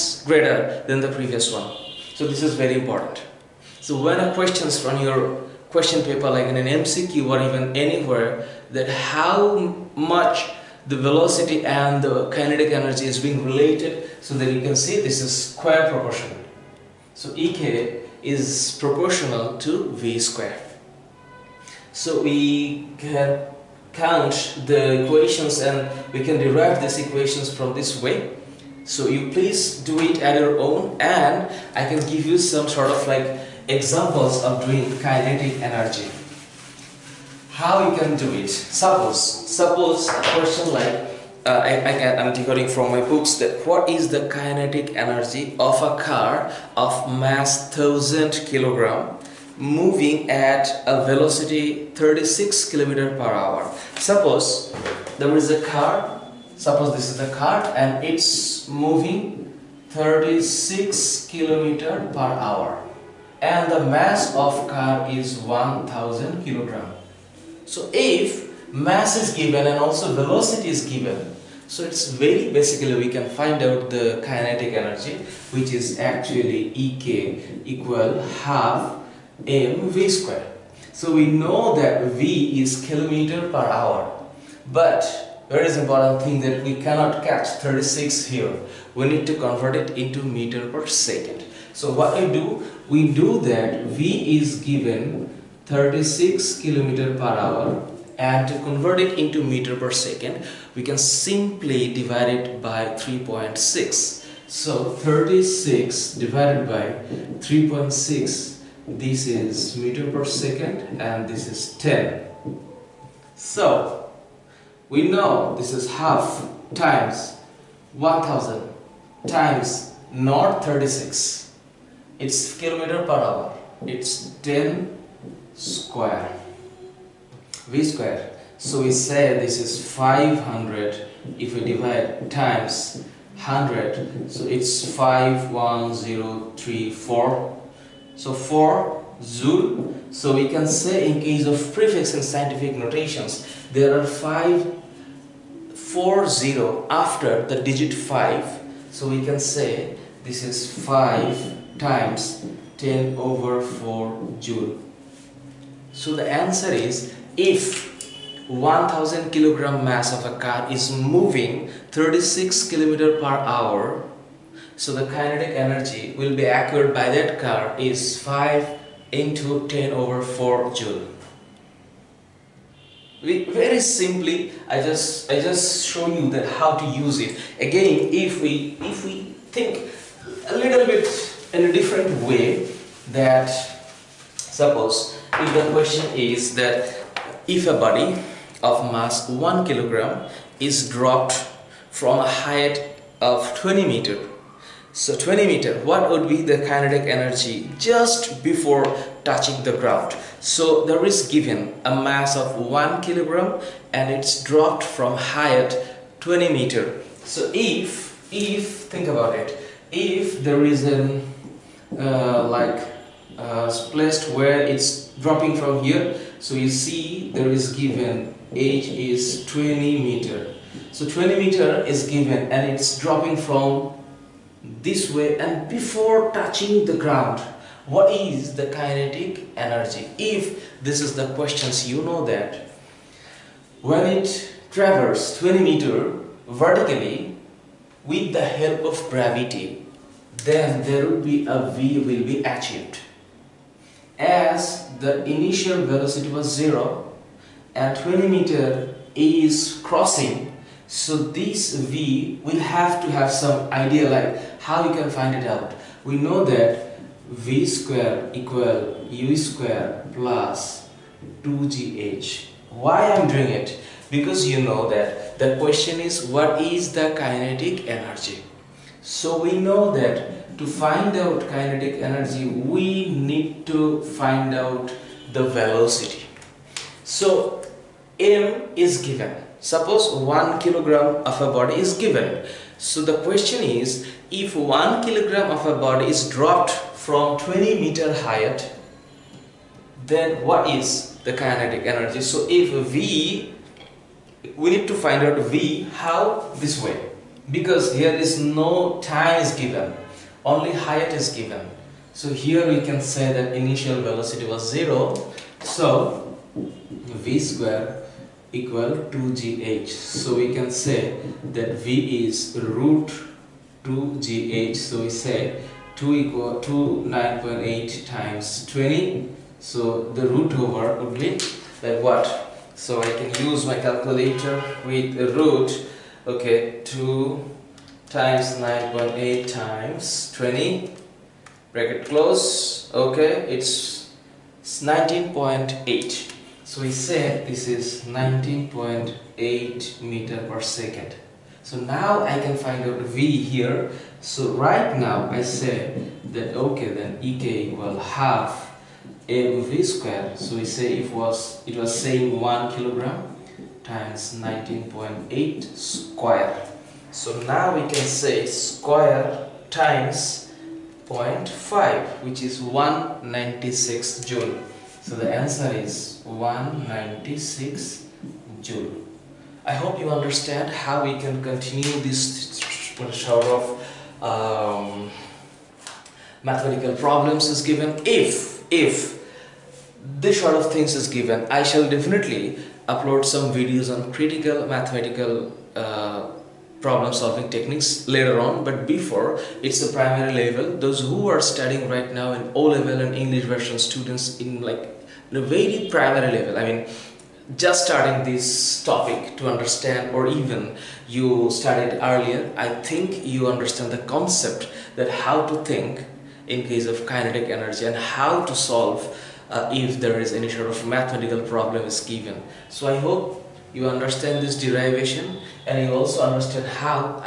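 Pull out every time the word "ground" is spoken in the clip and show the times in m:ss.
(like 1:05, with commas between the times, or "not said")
3:19, 3:46.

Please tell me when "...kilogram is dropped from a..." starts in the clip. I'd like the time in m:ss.
3:09.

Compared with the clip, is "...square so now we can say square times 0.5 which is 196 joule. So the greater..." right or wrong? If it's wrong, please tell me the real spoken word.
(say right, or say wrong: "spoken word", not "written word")
wrong: "answer", not "greater".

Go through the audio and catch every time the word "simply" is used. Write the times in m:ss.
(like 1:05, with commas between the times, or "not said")
1:40, 2:53.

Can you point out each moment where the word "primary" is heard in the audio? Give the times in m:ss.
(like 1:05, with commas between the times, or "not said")
6:29, 6:35.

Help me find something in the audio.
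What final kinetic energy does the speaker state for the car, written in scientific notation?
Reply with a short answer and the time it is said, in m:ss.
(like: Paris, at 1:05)
5 × 10^4 joules, at 2:48.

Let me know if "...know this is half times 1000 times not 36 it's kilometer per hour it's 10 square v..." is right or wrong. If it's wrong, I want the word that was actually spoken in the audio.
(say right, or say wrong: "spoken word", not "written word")
right.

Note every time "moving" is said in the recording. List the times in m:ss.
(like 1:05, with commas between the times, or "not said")
0:49, 0:58, 2:40.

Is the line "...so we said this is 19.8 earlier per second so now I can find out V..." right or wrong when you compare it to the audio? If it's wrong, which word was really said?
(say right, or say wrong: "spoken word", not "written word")
wrong: "meter", not "earlier".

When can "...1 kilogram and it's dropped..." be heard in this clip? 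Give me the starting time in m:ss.
3:22.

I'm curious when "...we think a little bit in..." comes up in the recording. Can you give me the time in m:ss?
2:59.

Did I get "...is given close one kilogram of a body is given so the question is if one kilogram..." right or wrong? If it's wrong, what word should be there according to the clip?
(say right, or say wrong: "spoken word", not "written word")
wrong: "suppose", not "close".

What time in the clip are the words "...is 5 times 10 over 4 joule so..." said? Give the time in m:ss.
2:30.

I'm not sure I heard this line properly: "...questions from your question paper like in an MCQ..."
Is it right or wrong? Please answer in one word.
right.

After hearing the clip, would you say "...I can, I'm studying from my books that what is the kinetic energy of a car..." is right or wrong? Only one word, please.
wrong.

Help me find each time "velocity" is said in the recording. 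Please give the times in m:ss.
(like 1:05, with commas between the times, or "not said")
0:10, 0:51, 1:10, 4:05, 4:35, 5:04.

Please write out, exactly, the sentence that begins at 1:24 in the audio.
But very important thing that we cannot catch 36 here.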